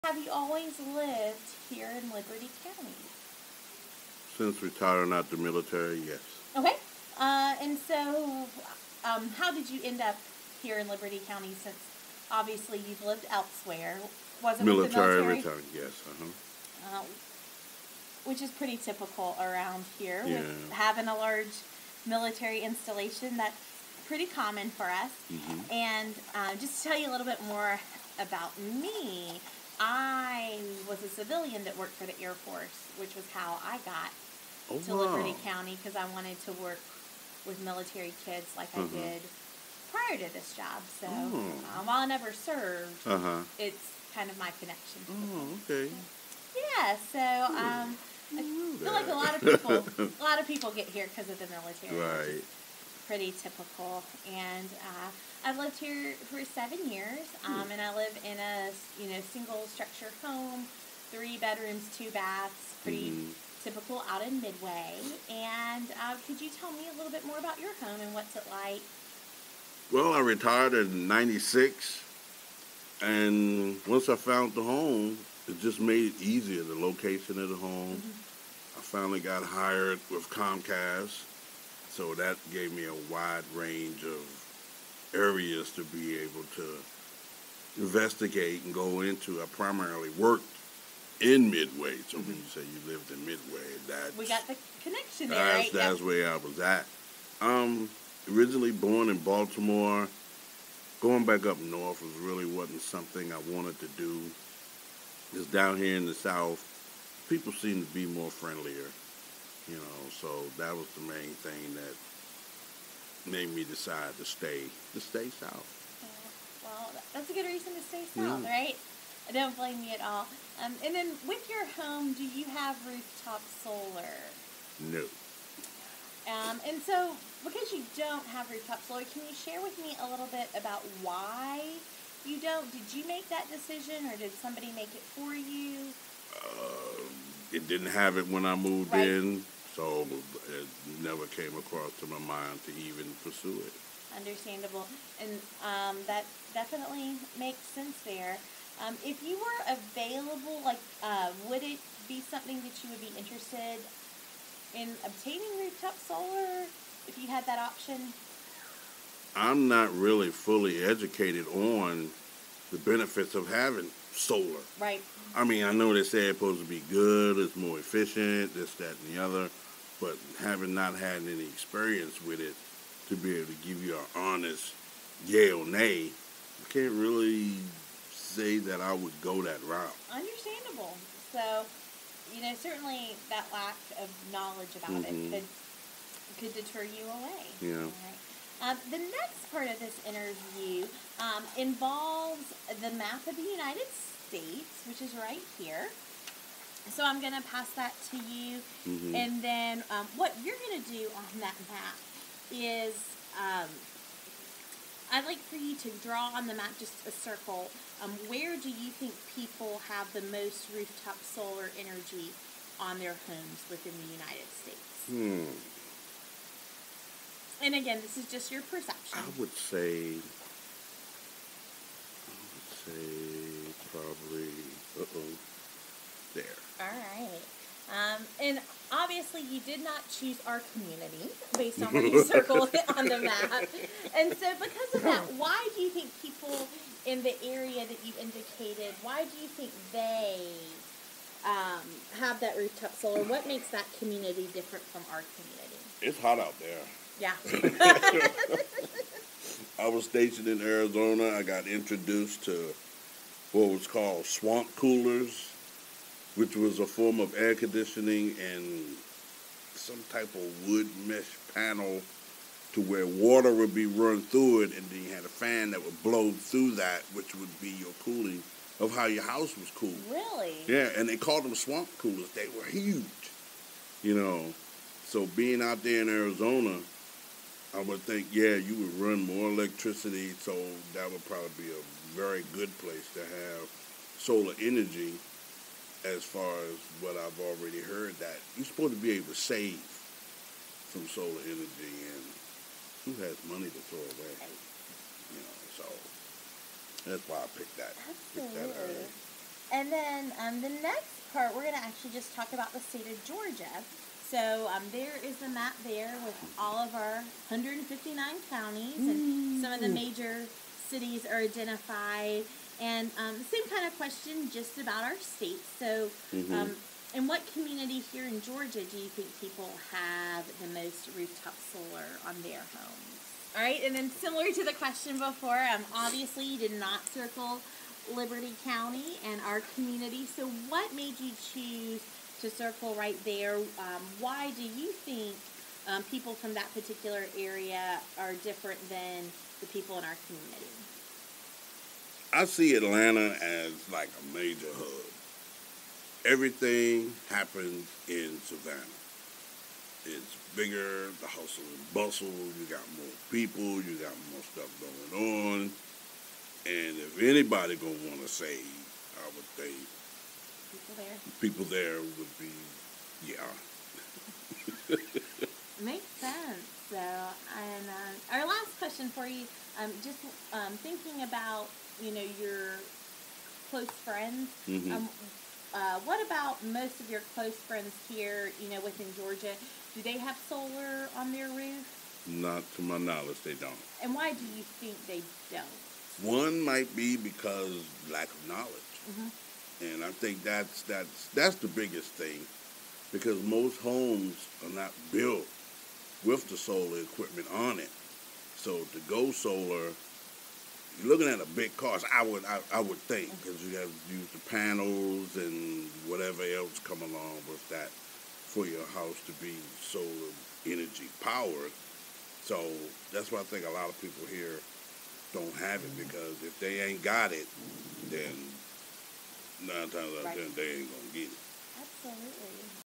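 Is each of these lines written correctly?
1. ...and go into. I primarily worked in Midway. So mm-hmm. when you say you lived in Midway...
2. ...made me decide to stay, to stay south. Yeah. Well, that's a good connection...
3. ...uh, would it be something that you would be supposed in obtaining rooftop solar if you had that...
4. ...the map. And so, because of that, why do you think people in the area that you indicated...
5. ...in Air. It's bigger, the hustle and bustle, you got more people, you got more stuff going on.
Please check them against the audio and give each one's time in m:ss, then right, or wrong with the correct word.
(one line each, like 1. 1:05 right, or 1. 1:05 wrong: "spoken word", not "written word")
1. 1:28 right
2. 1:53 wrong: "reason", not "connection"
3. 2:31 wrong: "interested", not "supposed"
4. 3:53 right
5. 5:48 wrong: "Savannah", not "Air".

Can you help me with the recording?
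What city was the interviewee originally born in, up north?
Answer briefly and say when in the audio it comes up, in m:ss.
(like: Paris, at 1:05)
Baltimore, at 1:39.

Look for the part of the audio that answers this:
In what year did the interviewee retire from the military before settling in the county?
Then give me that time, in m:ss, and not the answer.
1:11.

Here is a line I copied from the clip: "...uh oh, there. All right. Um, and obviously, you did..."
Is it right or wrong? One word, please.
right.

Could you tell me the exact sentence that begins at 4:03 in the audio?
What makes that community different from our community?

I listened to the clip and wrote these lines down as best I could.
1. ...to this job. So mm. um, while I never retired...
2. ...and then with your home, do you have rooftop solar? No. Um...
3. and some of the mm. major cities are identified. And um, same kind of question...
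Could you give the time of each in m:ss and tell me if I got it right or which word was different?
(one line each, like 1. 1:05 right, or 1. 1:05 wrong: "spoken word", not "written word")
1. 0:40 wrong: "served", not "retired"
2. 2:00 right
3. 5:09 right.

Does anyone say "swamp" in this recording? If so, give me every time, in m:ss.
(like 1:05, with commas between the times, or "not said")
4:14, 4:31.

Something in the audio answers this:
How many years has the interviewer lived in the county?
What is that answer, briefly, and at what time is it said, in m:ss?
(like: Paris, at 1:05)
7, at 0:56.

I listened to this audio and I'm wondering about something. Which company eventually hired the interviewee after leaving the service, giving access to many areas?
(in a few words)
Comcast.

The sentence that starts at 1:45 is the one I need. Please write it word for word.
Just down here in the South, people seem to be more friendlier.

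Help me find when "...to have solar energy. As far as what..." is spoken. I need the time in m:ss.
4:43.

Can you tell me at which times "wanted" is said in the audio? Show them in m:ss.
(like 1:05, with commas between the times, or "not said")
0:36, 1:43.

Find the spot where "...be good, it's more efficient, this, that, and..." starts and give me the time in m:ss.
2:46.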